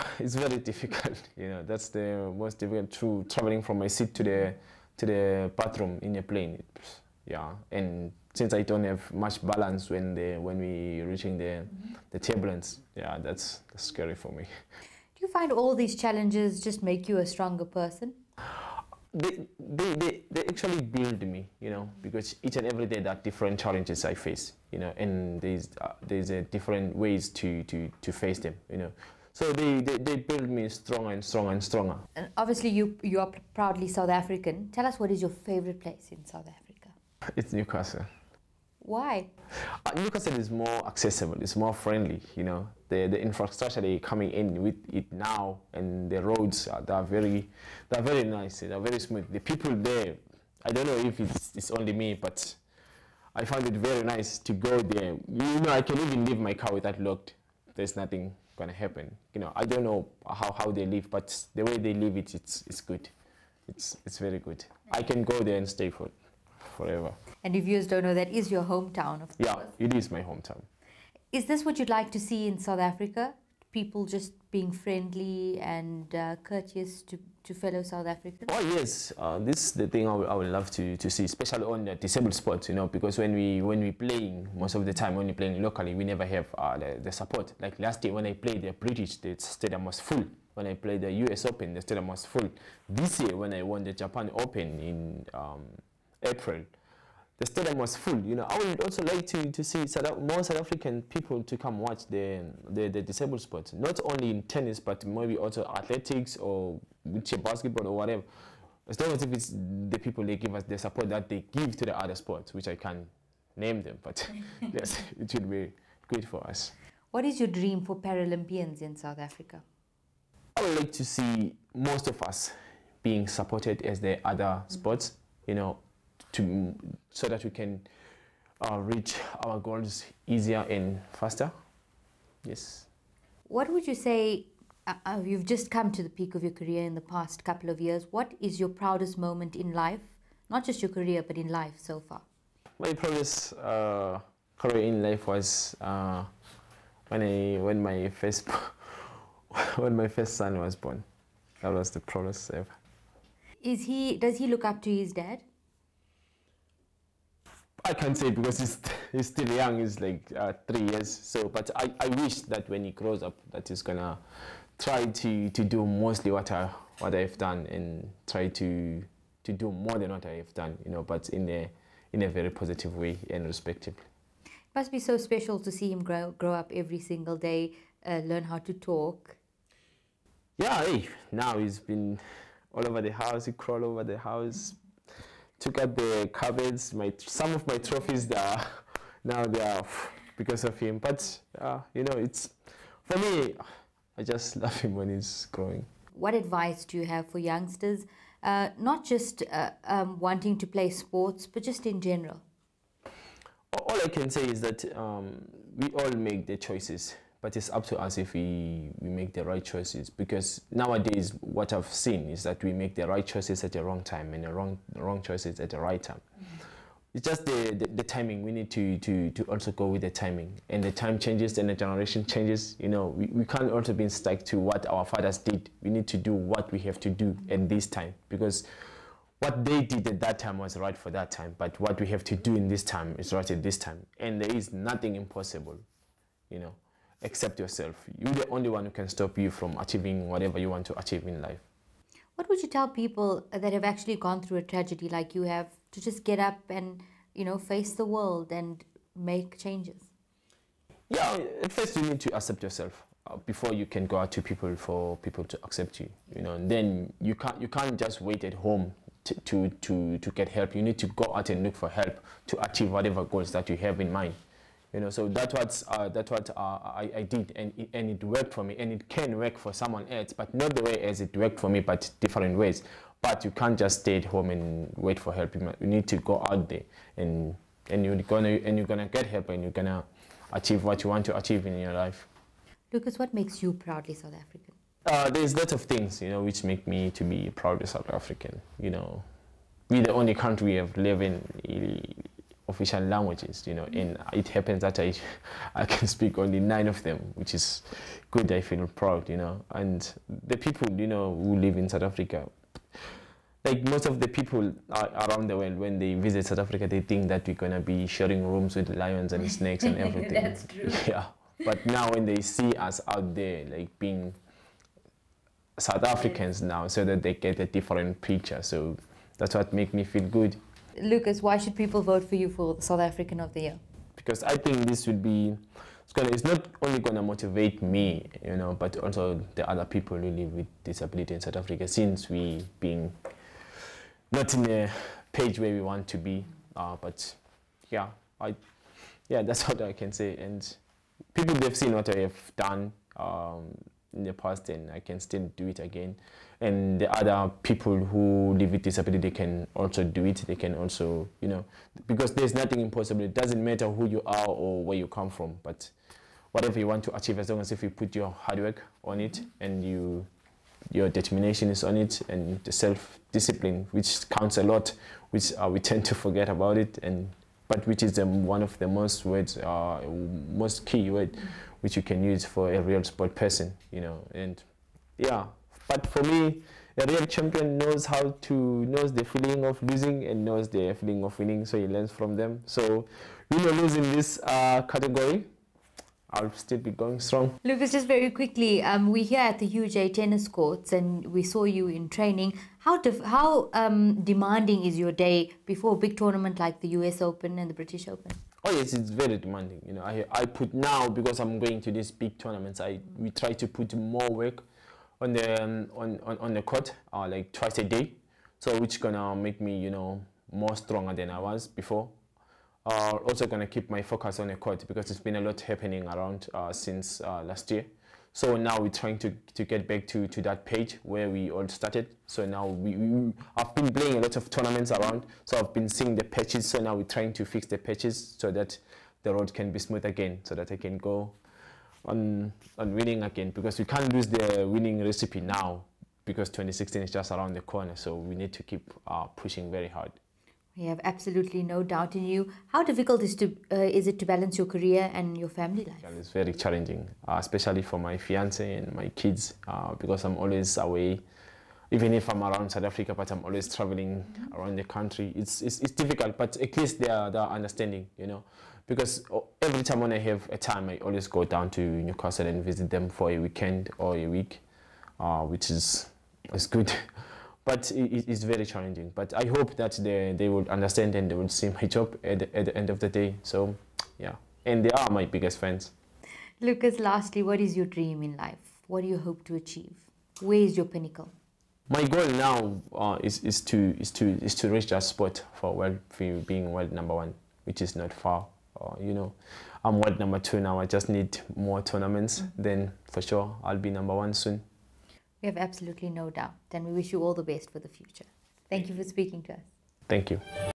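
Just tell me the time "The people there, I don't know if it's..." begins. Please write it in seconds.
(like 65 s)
49 s.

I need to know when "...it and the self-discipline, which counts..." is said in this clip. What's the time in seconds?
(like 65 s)
361 s.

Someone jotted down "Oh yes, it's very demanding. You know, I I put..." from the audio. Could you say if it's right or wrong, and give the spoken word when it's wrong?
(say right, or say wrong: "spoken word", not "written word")
right.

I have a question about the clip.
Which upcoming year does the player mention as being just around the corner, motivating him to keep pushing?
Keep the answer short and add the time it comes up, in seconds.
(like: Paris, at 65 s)
2016, at 436 s.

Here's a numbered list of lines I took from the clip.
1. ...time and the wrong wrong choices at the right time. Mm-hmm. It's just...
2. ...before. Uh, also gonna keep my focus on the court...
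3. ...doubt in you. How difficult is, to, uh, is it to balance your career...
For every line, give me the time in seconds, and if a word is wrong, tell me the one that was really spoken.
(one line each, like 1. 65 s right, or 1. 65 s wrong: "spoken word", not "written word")
1. 214 s right
2. 411 s right
3. 441 s right.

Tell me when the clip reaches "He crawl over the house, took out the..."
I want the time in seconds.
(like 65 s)
183 s.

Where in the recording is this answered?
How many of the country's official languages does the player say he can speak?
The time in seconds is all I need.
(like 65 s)
296 s.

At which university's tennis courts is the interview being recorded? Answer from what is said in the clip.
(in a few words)
UJ.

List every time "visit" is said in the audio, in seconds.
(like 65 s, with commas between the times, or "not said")
306 s, 462 s.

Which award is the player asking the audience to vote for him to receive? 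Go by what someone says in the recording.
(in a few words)
South African of the Year.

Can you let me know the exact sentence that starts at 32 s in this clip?
And obviously you, you are proudly South African.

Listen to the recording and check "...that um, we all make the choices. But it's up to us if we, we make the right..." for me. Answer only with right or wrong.
right.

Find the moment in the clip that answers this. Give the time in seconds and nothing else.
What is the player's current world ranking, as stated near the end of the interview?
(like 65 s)
489 s.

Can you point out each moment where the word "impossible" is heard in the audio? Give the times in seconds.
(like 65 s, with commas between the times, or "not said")
235 s, 352 s.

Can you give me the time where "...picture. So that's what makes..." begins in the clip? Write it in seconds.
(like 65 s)
318 s.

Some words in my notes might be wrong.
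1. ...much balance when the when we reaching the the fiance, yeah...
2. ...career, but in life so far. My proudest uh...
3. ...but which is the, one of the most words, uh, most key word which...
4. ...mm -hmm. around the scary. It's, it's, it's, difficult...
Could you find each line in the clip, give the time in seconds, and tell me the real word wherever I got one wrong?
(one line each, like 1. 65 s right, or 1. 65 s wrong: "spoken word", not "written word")
1. 9 s wrong: "turbulence", not "fiance"
2. 140 s right
3. 367 s right
4. 454 s wrong: "country", not "scary".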